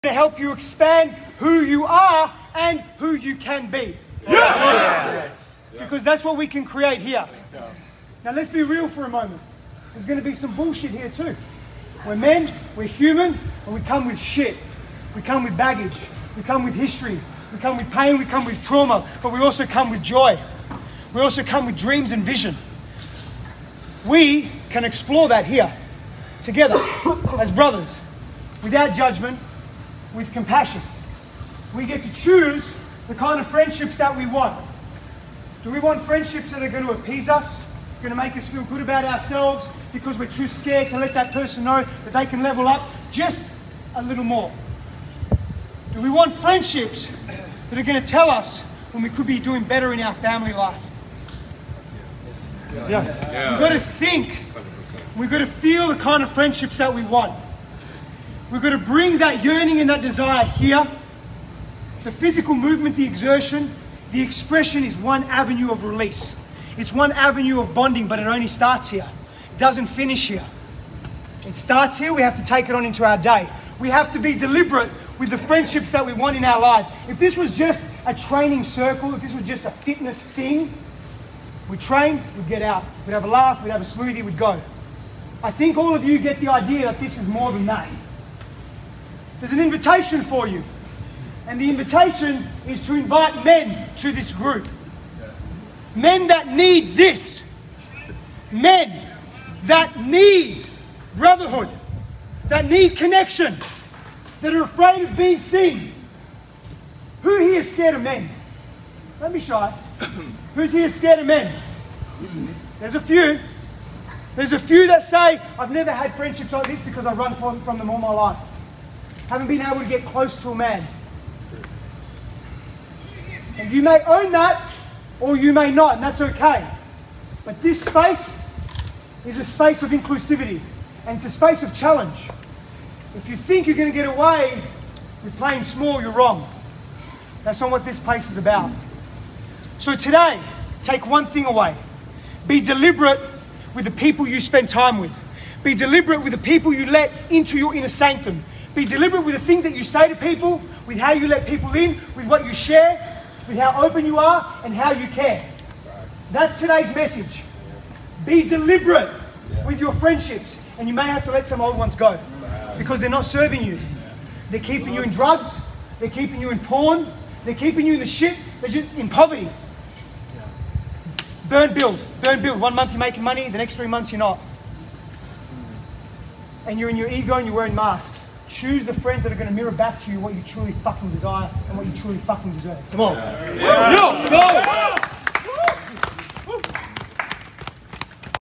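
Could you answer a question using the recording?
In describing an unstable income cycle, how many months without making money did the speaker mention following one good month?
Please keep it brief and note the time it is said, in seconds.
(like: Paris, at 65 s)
3, at 173 s.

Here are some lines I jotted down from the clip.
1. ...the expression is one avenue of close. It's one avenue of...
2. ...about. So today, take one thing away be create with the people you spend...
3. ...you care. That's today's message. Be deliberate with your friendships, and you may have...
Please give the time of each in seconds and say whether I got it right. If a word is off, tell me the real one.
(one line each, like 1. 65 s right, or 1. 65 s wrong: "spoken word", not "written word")
1. 64 s wrong: "release", not "close"
2. 138 s wrong: "deliberate", not "create"
3. 154 s right.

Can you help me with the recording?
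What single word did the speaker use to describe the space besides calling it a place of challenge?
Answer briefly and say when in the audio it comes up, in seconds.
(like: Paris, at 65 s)
inclusivity, at 129 s.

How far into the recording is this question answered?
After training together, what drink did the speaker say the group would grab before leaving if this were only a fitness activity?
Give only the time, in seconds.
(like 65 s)
83 s.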